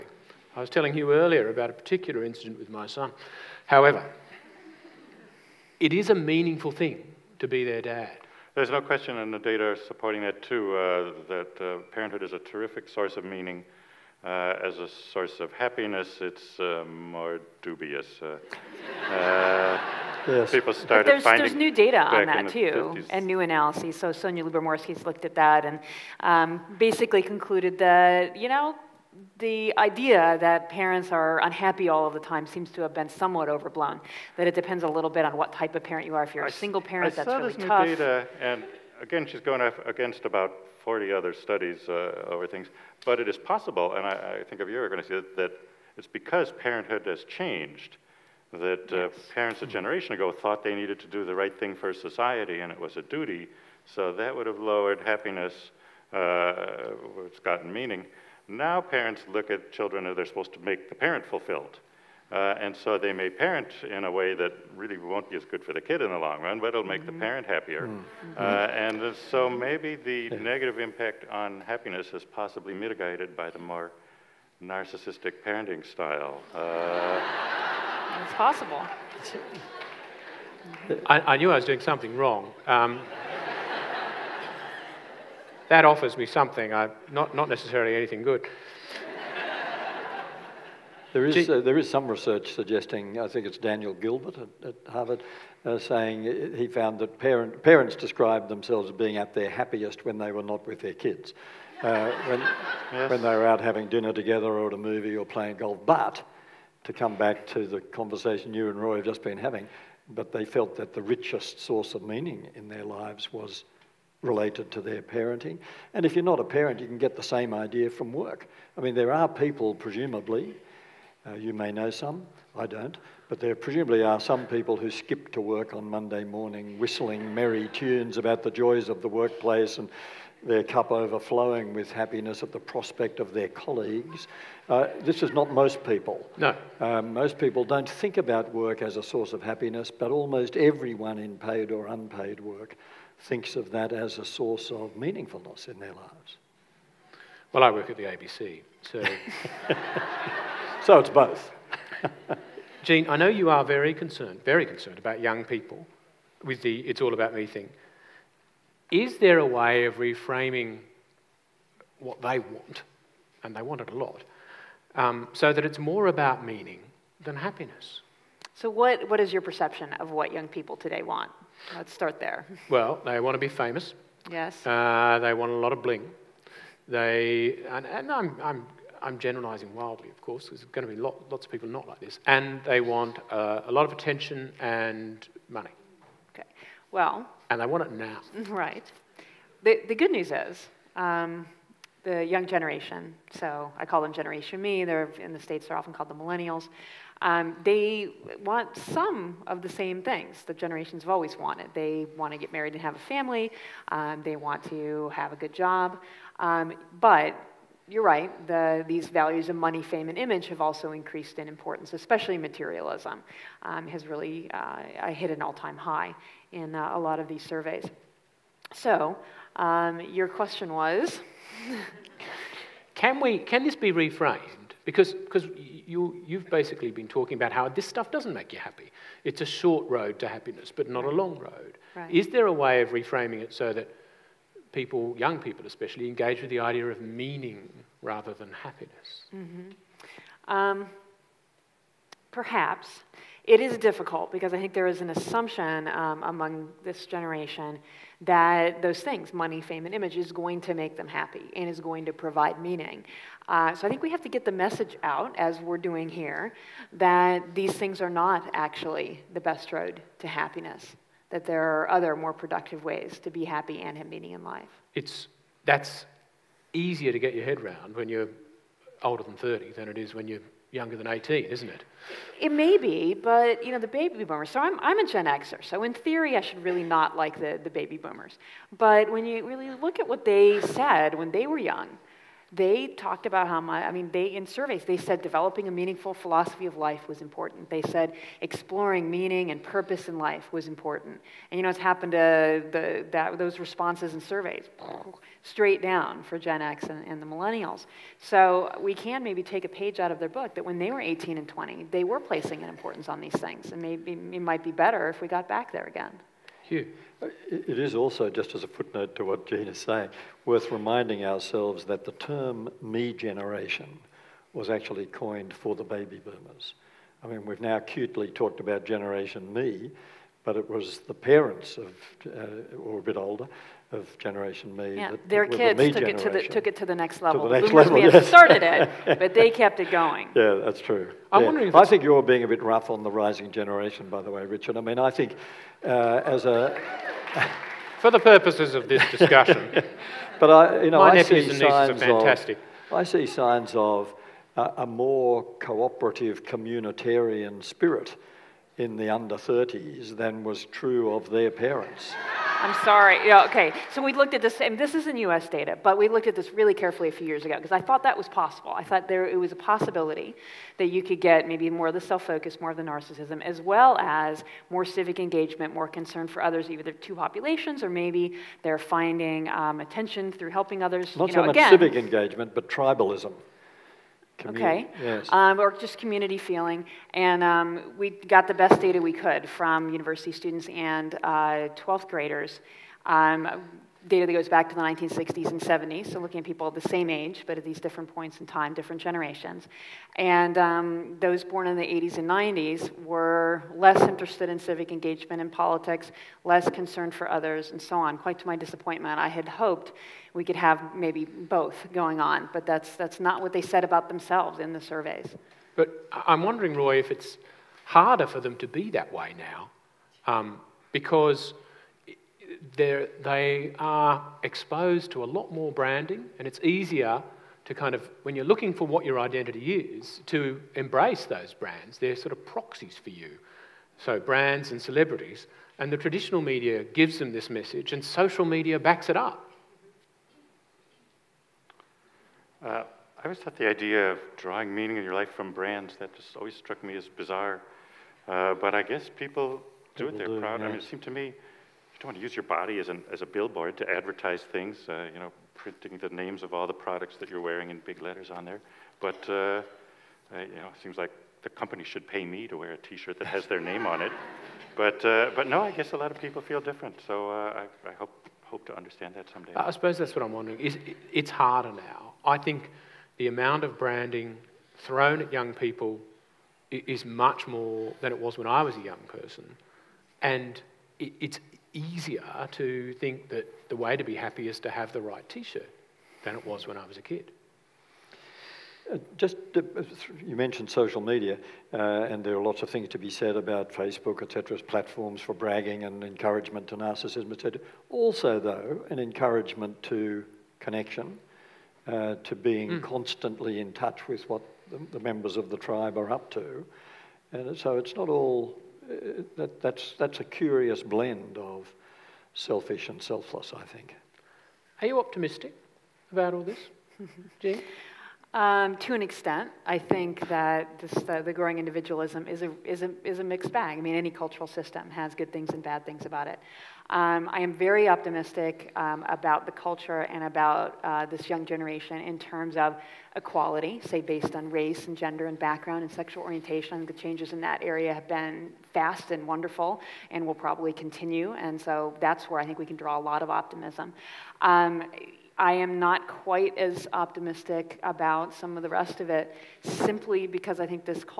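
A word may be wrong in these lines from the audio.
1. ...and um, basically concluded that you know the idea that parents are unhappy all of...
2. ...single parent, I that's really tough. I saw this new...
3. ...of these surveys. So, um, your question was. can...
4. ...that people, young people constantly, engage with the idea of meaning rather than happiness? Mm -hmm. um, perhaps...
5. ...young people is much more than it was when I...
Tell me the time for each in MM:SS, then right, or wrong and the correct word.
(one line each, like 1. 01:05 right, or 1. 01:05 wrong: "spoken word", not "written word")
1. 00:25 right
2. 00:36 right
3. 03:37 right
4. 03:53 wrong: "especially", not "constantly"
5. 07:45 right.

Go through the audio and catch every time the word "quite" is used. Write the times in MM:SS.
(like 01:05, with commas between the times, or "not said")
06:38, 08:56.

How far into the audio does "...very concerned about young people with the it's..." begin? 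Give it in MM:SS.
02:34.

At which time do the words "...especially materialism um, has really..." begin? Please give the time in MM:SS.
03:31.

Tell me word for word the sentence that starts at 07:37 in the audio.
So uh, I, I hope, hope to understand that someday.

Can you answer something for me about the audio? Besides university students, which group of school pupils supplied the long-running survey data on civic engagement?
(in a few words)
12th graders.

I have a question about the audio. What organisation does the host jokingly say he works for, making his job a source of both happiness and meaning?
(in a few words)
ABC.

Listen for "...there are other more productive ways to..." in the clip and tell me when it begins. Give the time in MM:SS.
04:21.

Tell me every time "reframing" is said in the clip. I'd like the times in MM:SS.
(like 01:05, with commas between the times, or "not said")
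02:39, 03:52.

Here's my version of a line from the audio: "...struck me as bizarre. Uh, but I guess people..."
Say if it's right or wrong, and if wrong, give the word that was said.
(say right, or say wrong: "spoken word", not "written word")
right.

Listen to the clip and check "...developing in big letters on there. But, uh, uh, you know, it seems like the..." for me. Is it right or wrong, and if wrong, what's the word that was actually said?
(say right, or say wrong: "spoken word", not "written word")
wrong: "wearing", not "developing".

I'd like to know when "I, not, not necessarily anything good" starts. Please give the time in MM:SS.
01:26.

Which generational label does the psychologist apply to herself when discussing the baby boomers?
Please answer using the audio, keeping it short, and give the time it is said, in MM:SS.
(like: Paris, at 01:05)
Gen Xer, at 04:35.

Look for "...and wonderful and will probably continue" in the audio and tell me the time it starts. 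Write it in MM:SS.
08:49.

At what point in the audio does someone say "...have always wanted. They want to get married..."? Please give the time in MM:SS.
03:21.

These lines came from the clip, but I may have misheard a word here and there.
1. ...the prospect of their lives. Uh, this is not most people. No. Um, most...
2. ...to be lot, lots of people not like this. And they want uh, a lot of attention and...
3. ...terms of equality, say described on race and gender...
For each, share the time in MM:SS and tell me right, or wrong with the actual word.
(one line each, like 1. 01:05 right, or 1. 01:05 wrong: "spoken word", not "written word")
1. 02:12 wrong: "colleagues", not "lives"
2. 03:00 right
3. 08:42 wrong: "based", not "described".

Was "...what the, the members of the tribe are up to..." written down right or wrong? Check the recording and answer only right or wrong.
right.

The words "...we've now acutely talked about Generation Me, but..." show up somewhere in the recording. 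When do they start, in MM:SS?
05:17.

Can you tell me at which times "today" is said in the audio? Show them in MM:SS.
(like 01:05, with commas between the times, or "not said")
02:50.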